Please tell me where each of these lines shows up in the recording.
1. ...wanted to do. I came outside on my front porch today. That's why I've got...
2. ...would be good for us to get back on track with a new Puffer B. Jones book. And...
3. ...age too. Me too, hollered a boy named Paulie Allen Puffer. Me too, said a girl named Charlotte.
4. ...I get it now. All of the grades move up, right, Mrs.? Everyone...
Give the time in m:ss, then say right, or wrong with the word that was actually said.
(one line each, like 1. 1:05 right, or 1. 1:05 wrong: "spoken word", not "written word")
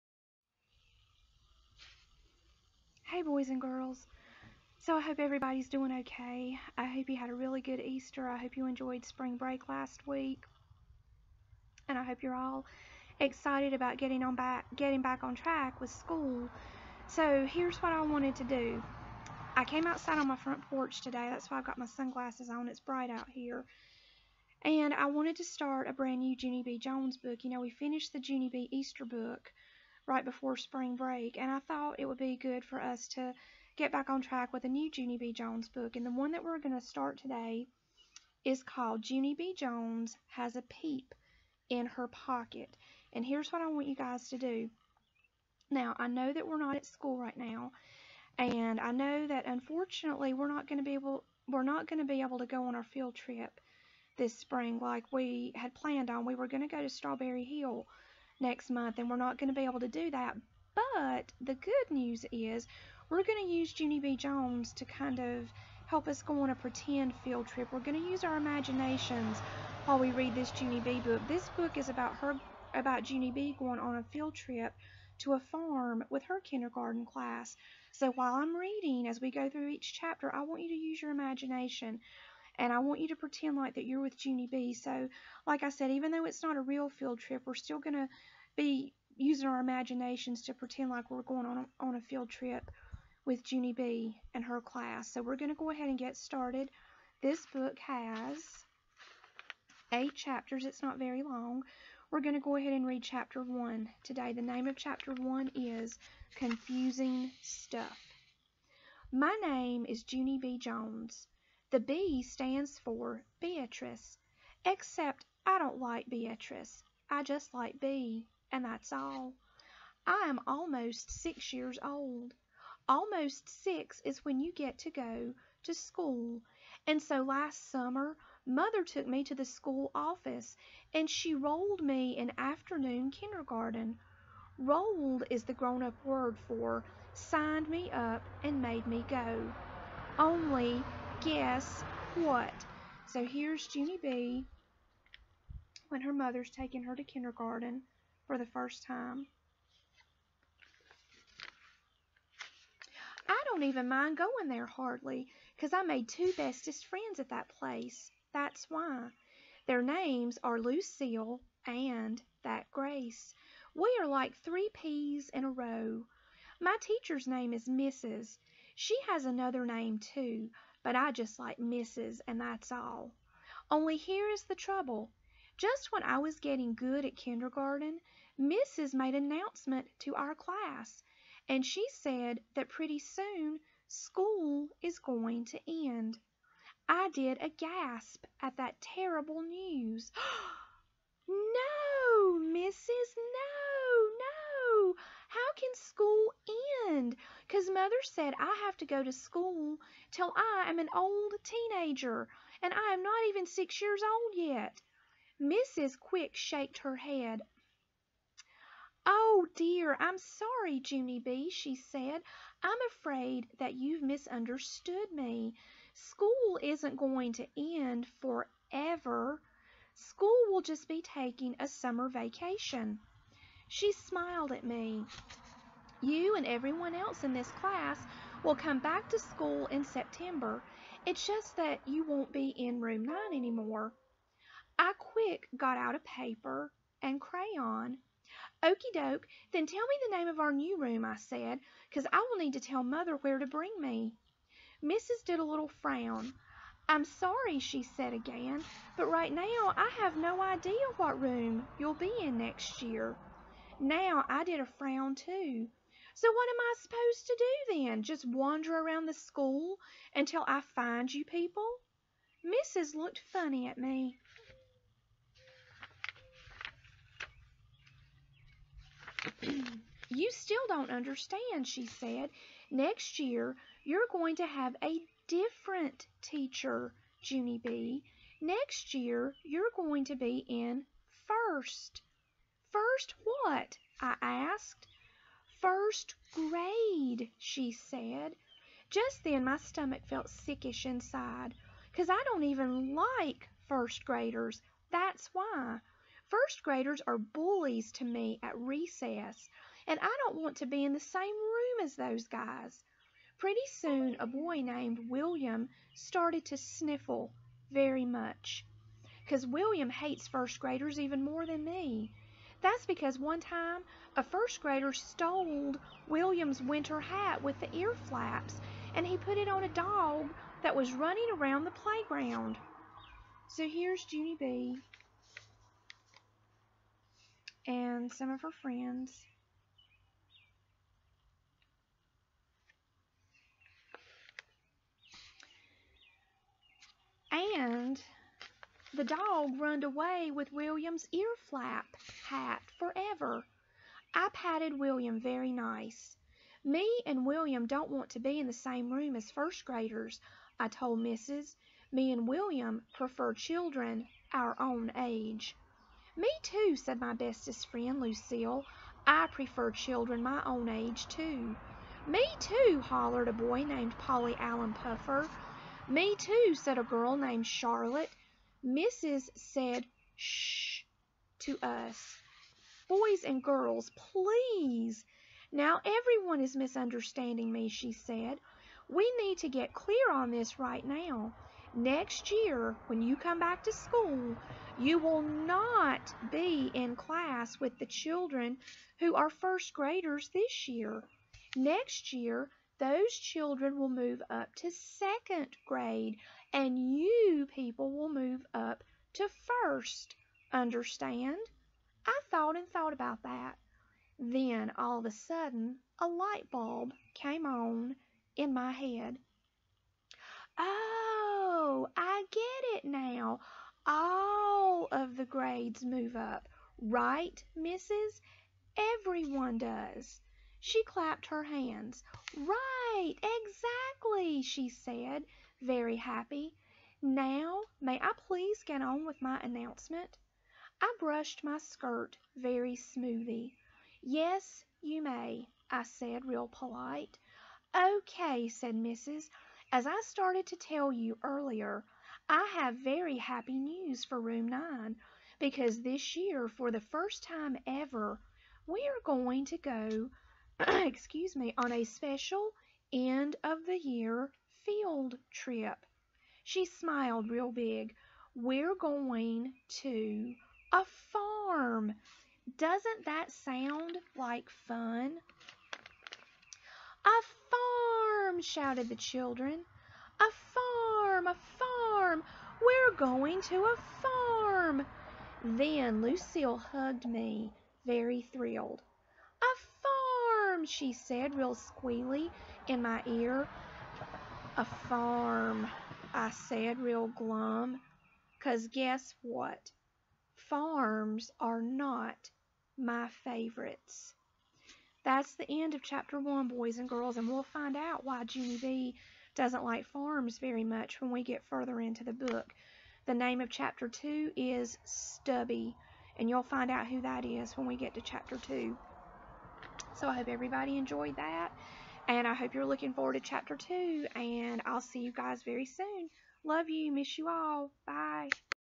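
1. 0:18 right
2. 0:32 wrong: "Junie", not "Puffer"
3. 6:00 right
4. 6:51 right.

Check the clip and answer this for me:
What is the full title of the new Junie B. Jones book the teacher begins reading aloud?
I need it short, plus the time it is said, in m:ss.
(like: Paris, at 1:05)
Junie B. Jones Has a Peep in Her Pocket, at 0:39.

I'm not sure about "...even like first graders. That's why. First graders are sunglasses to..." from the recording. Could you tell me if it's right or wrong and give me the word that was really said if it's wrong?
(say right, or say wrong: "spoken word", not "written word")
wrong: "bullies", not "sunglasses".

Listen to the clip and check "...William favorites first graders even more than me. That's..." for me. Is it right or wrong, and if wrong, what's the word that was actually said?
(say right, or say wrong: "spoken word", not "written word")
wrong: "hates", not "favorites".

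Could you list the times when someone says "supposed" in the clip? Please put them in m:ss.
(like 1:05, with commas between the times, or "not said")
4:16.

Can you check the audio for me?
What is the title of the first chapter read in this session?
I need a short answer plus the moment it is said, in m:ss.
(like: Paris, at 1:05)
Confusing Stuff, at 1:46.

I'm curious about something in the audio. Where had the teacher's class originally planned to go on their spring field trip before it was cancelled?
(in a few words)
Strawberry Hill.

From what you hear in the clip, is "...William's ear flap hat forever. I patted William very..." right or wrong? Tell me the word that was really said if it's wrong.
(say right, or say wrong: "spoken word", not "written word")
right.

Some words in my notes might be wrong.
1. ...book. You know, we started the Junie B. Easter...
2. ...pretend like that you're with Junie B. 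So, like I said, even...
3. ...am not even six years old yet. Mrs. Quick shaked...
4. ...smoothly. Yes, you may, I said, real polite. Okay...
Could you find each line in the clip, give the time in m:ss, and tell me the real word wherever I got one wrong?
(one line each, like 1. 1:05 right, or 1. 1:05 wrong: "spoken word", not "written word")
1. 0:27 wrong: "finished", not "started"
2. 1:23 right
3. 3:22 right
4. 7:12 right.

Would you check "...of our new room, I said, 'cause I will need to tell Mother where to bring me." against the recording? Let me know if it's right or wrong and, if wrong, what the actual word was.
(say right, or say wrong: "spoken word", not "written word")
right.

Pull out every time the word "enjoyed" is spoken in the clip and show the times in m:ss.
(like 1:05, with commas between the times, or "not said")
0:08, 8:30.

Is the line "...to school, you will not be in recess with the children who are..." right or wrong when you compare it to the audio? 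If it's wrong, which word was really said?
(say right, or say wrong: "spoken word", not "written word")
wrong: "class", not "recess".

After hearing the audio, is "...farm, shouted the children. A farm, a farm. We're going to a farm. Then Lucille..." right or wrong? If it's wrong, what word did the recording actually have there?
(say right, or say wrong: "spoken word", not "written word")
right.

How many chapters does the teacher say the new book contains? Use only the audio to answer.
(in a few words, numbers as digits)
8.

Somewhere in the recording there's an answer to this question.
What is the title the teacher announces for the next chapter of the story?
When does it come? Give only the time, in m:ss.
8:24.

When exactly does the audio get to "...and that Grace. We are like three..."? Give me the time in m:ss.
2:41.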